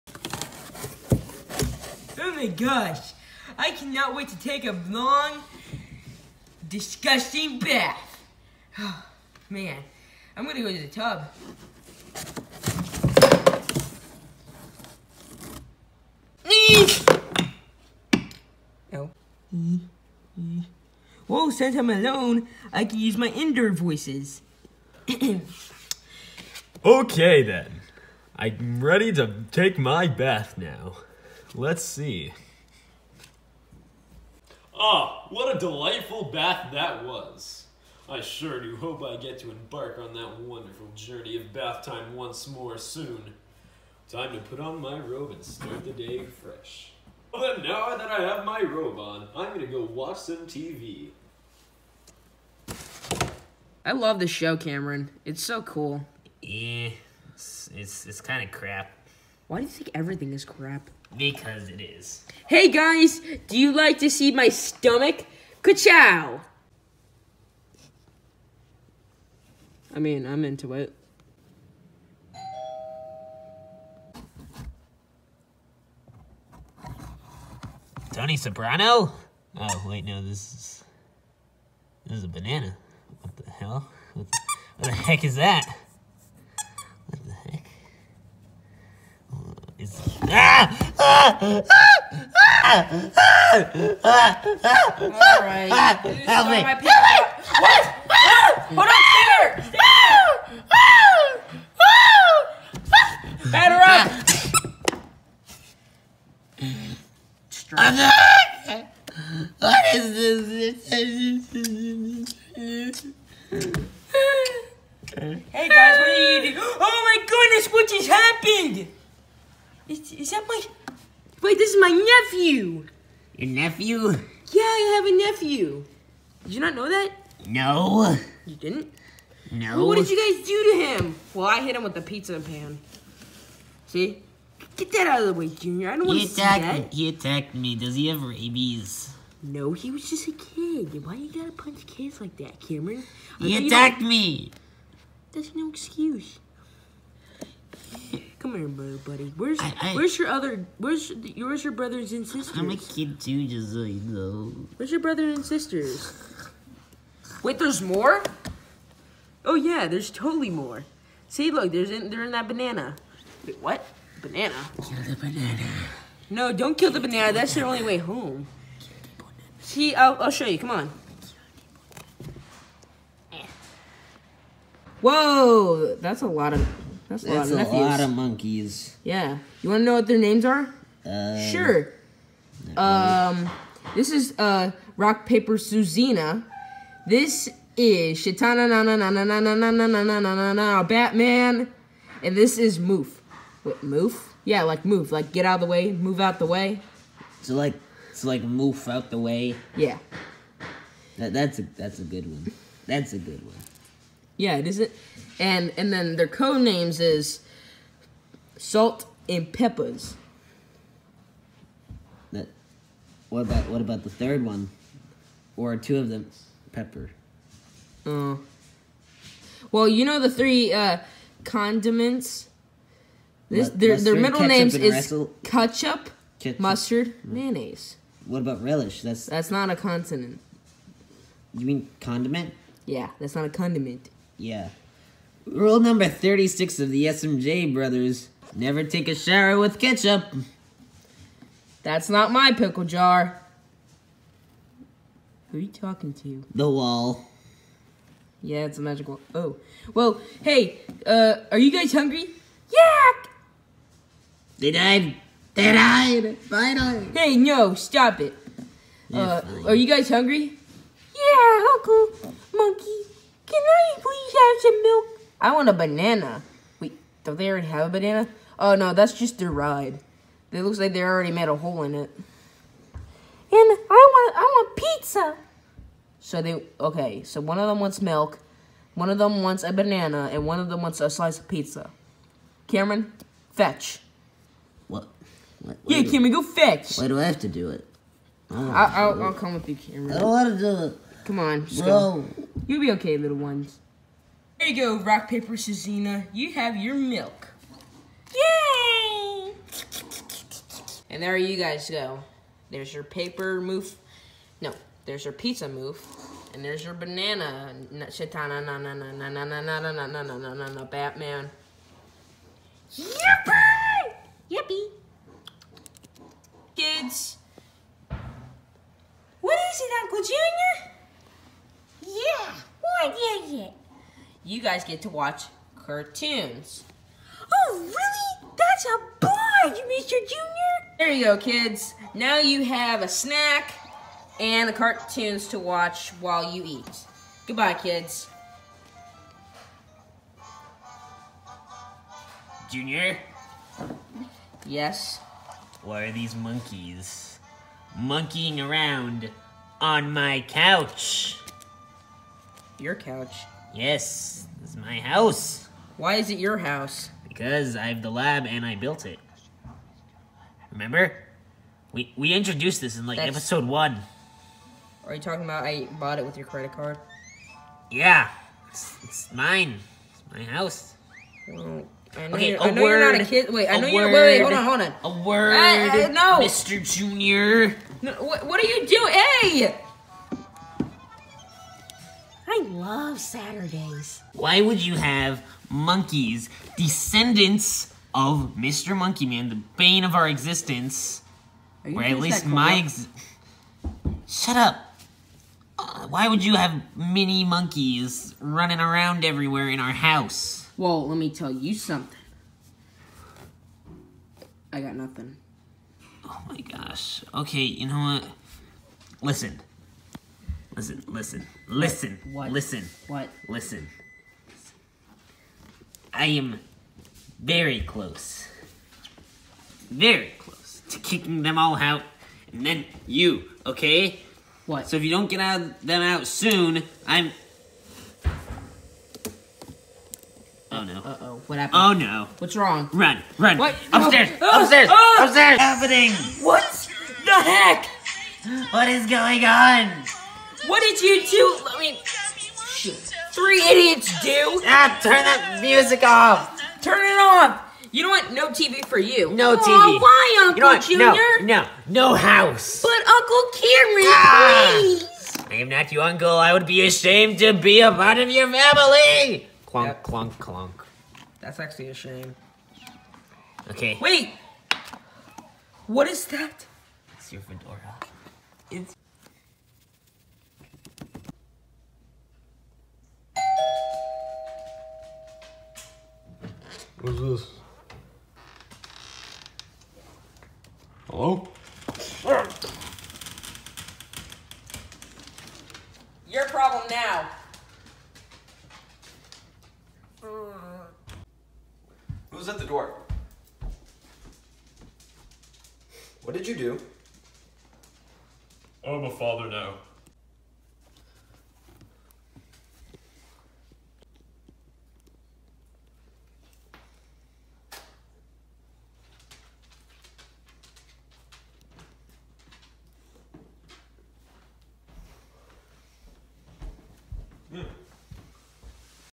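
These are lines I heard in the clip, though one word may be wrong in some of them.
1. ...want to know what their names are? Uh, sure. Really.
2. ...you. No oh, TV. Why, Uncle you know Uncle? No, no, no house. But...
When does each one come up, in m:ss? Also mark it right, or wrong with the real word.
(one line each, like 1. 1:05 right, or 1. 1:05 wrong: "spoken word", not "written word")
1. 2:59 right
2. 7:28 wrong: "Junior", not "Uncle".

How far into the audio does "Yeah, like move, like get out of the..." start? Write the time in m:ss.
3:14.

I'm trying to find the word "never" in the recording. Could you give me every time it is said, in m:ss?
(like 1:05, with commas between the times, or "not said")
3:58.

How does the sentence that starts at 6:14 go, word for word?
Wait, wait, hold on, hold on.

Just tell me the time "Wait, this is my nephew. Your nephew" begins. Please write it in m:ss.
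2:01.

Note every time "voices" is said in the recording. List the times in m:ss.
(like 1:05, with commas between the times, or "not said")
0:23.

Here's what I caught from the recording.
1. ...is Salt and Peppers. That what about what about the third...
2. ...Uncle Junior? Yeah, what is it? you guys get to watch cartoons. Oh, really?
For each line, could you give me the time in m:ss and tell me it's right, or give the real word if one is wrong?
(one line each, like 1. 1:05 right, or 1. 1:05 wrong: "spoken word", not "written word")
1. 3:26 right
2. 5:20 right.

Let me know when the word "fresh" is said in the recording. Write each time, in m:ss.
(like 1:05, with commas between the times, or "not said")
0:46.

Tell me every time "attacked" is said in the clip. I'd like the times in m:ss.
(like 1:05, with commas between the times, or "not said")
2:17, 2:23.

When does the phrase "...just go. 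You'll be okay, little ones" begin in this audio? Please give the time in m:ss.
4:51.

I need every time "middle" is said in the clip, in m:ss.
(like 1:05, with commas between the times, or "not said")
3:44.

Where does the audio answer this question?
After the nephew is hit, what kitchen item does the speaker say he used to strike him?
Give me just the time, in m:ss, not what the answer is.
2:12.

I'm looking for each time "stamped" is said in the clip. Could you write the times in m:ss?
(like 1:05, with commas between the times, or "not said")
not said.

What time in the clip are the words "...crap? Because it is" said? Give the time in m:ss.
1:00.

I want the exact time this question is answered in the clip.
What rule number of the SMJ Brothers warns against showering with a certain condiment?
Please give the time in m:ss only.
3:55.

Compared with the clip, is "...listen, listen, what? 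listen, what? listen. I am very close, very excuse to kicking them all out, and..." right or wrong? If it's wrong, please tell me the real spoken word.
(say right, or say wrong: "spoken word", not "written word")
wrong: "close", not "excuse".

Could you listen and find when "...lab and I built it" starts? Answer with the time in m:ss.
5:58.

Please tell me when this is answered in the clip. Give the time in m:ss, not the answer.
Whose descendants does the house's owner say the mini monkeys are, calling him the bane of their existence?
6:28.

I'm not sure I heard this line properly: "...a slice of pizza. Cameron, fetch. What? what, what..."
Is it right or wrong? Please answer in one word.
right.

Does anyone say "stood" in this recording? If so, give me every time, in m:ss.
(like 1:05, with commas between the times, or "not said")
not said.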